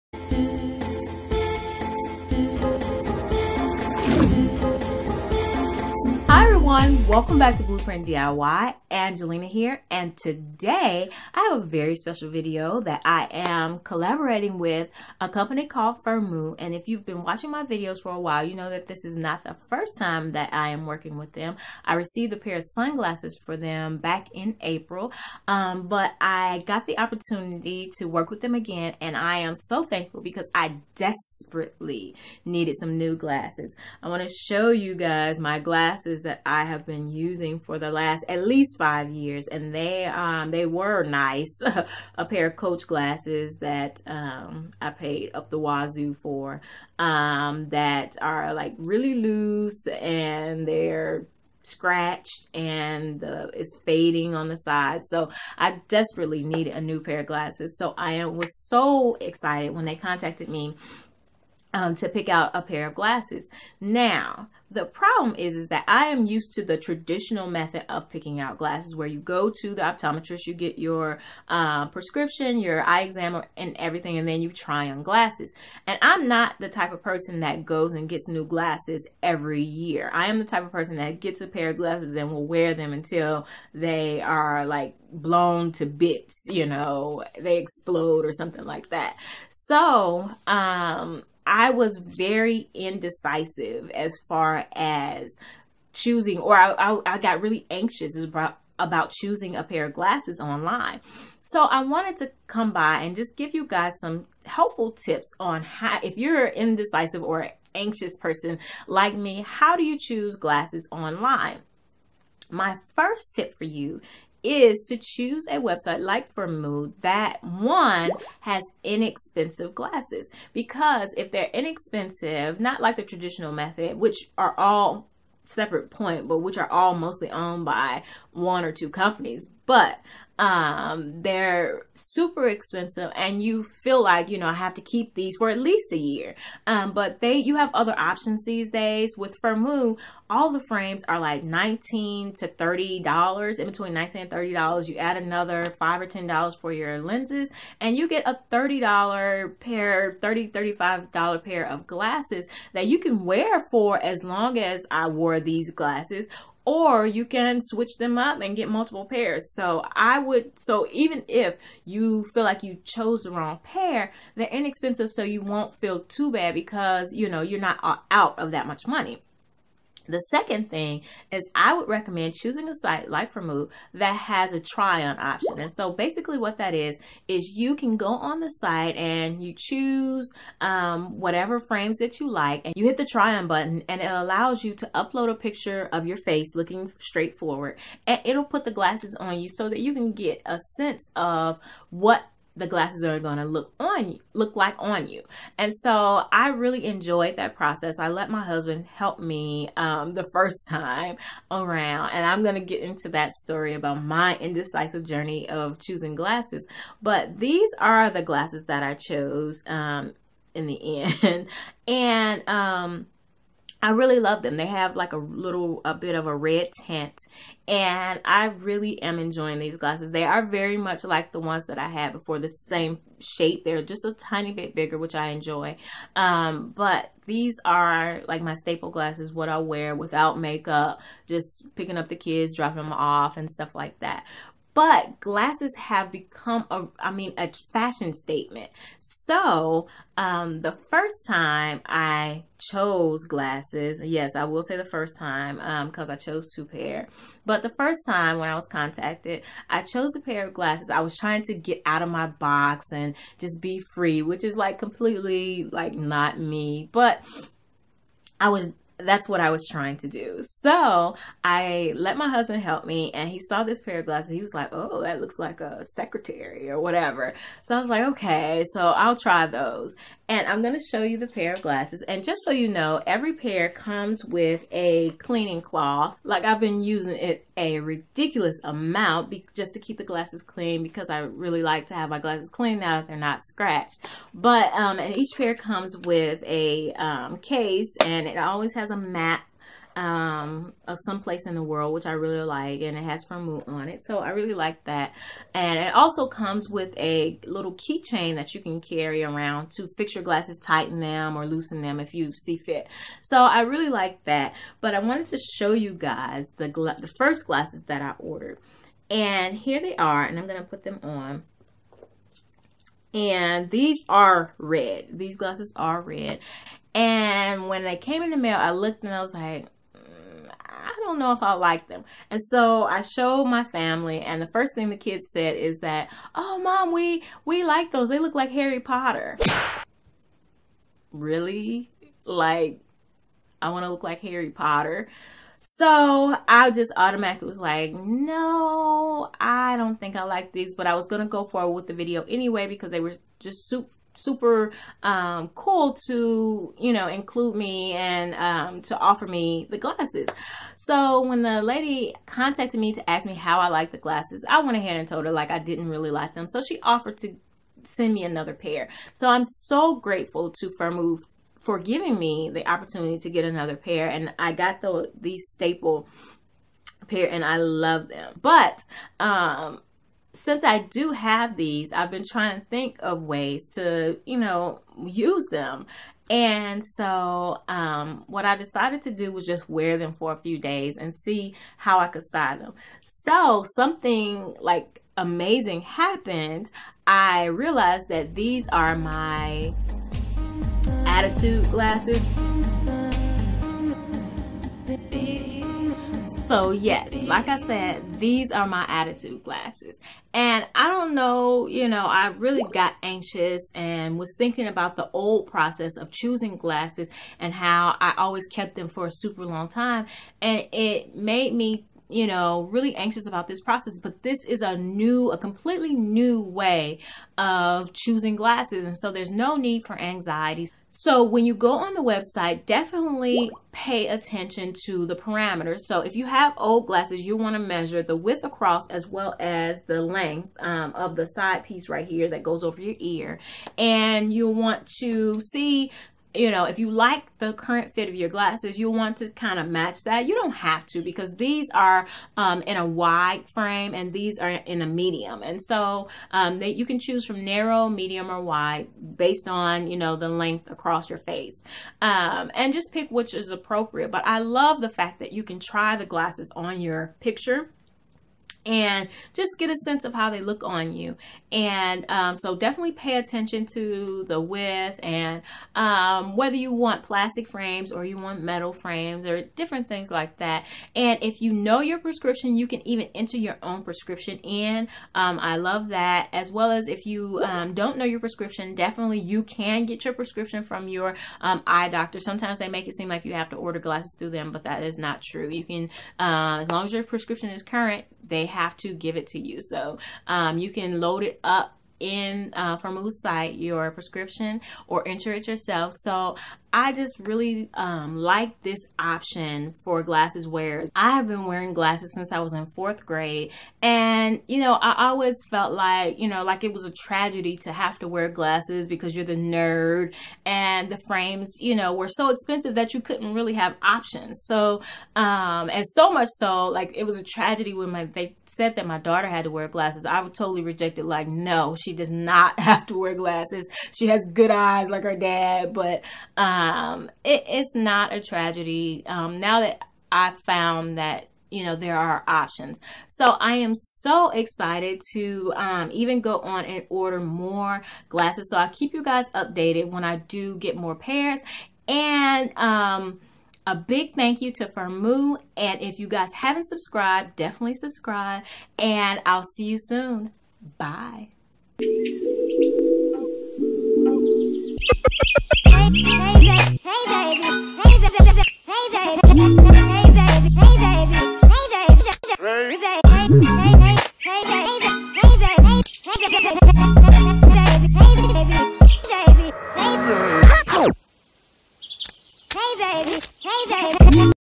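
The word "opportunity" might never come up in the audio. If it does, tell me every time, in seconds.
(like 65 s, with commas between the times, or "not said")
26 s, 362 s.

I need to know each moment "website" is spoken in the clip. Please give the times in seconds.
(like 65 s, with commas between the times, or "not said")
115 s, 422 s.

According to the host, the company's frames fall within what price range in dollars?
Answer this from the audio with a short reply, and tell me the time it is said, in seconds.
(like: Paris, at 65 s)
19 to 30 dollars, at 143 s.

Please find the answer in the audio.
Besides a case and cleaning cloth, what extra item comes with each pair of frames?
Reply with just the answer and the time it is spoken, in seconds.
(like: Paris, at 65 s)
keychain, at 297 s.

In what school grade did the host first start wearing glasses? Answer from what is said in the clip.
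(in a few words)
fourth grade.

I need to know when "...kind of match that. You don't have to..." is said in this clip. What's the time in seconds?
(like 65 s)
439 s.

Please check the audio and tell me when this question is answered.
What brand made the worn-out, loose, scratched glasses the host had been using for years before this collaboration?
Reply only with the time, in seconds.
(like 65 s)
42 s.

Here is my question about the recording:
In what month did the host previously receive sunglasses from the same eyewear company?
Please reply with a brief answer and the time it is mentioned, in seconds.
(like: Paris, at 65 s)
April, at 24 s.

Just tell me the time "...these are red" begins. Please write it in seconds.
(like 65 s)
313 s.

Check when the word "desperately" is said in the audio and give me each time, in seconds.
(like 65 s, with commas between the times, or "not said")
30 s, 55 s.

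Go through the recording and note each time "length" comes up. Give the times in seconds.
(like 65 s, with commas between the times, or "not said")
430 s, 450 s.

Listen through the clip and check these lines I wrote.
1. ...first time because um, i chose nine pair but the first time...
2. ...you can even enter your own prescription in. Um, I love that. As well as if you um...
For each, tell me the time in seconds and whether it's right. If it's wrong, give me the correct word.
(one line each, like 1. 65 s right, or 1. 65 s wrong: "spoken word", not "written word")
1. 244 s wrong: "two", not "nine"
2. 472 s right.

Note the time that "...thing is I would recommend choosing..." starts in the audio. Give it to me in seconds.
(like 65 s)
170 s.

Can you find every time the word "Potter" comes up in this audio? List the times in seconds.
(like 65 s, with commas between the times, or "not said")
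328 s, 334 s.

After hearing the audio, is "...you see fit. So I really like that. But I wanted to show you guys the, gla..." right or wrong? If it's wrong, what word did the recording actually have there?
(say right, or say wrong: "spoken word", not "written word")
right.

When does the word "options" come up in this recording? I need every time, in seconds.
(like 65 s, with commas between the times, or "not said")
137 s, 175 s, 498 s, 513 s, 532 s.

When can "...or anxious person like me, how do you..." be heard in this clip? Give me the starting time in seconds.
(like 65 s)
107 s.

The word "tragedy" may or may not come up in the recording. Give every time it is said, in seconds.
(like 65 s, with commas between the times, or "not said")
506 s, 517 s, 528 s.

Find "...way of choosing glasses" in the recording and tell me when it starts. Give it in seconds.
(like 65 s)
416 s.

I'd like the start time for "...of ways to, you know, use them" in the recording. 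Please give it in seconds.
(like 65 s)
373 s.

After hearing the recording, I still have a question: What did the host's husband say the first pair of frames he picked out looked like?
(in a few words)
a secretary.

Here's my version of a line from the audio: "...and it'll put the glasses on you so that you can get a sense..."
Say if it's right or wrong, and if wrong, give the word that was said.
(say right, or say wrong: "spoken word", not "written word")
right.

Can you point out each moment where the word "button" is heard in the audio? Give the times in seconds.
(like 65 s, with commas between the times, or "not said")
183 s.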